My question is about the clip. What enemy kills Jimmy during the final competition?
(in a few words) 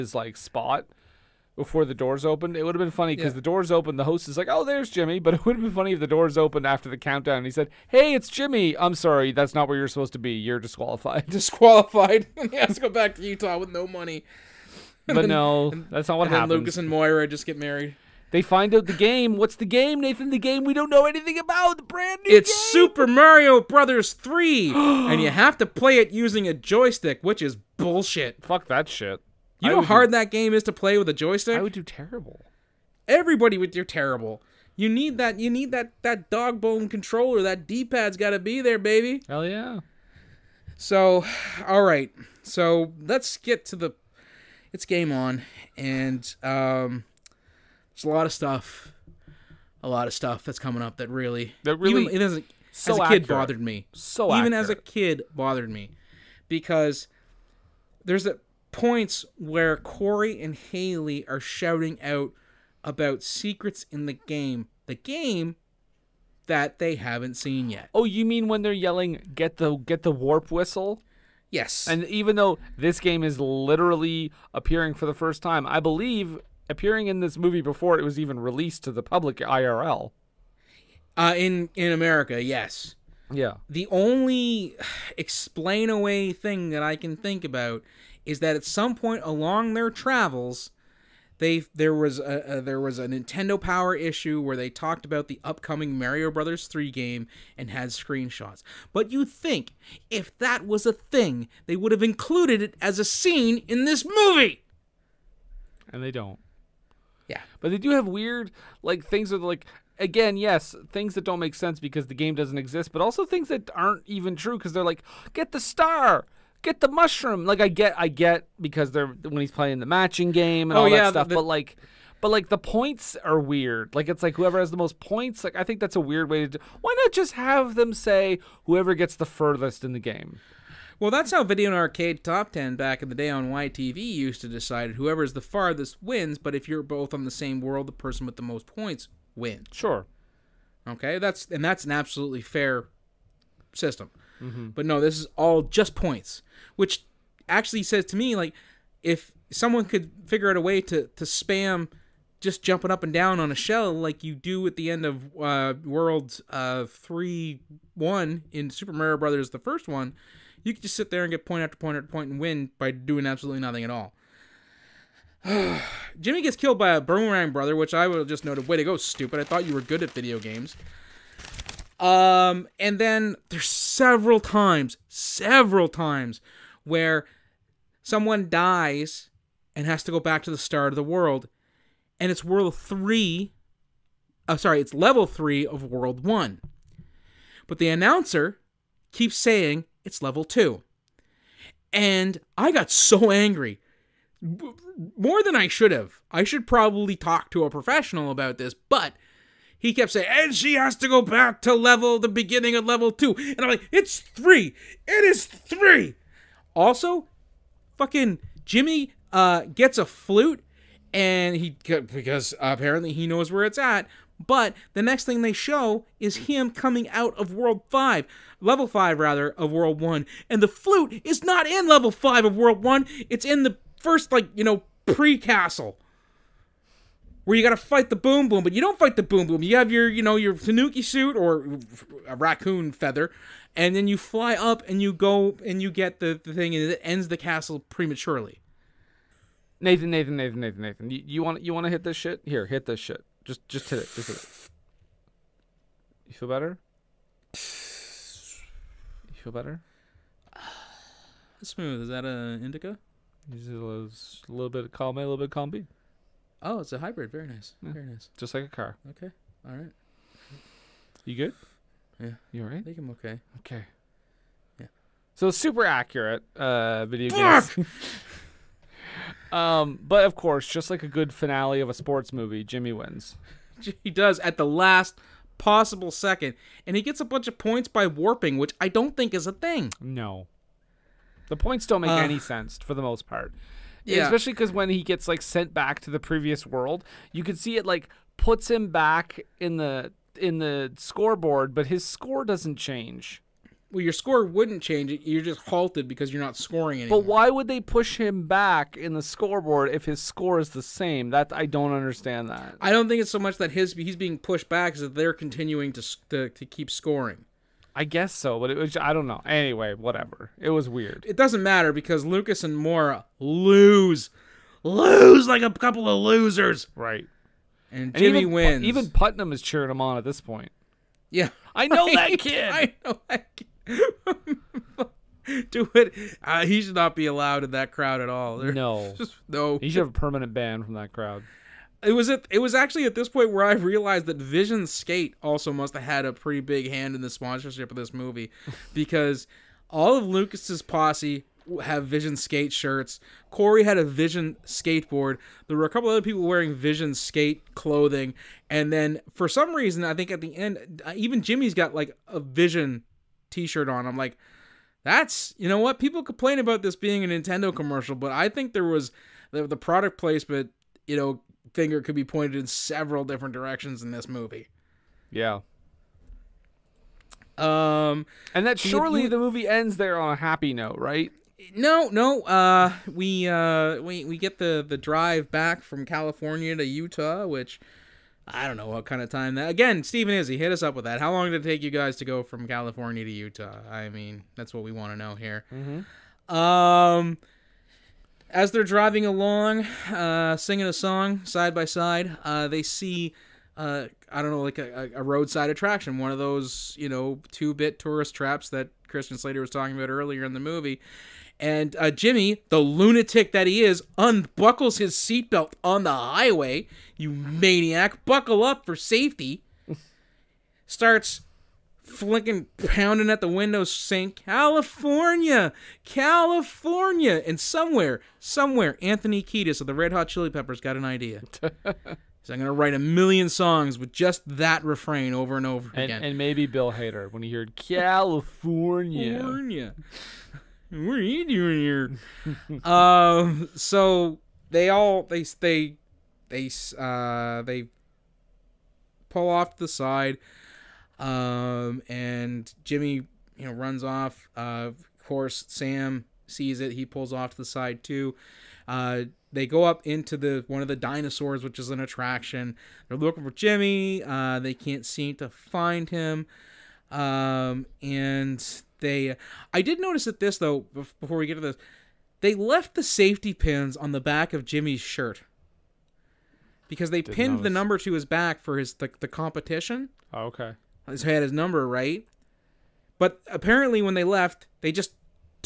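boomerang brother.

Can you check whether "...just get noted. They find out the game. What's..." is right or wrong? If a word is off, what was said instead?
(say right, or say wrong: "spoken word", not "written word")
wrong: "married", not "noted".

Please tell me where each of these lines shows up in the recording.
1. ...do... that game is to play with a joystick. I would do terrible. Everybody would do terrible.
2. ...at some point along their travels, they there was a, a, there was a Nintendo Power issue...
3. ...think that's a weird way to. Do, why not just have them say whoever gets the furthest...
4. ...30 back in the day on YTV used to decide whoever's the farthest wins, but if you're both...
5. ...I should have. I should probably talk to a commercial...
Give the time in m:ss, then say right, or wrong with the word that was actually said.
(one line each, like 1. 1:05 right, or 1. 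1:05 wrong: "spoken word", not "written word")
1. 0:30 right
2. 1:28 right
3. 2:05 right
4. 2:12 wrong: "10", not "30"
5. 3:15 wrong: "professional", not "commercial".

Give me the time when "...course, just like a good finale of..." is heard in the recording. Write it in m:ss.
4:30.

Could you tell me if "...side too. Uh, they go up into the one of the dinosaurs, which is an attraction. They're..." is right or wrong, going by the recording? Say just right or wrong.
right.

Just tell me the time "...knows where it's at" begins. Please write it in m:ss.
3:33.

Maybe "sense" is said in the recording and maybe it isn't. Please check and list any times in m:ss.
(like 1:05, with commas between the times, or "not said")
1:51, 4:42.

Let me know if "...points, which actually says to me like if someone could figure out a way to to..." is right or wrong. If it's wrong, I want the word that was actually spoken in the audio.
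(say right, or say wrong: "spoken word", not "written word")
right.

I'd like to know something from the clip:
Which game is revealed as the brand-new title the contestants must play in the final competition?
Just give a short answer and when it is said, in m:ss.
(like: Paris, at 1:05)
Super Mario Brothers 3, at 0:22.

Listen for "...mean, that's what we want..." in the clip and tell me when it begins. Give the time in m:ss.
6:24.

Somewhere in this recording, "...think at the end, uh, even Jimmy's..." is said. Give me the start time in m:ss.
5:50.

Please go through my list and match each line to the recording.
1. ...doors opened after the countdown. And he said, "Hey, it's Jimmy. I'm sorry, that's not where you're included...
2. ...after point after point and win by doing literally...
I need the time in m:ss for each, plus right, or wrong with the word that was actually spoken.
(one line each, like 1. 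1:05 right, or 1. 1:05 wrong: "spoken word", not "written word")
1. 0:06 wrong: "supposed", not "included"
2. 2:41 wrong: "absolutely", not "literally".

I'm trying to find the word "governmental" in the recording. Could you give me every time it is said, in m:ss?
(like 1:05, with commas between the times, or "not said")
not said.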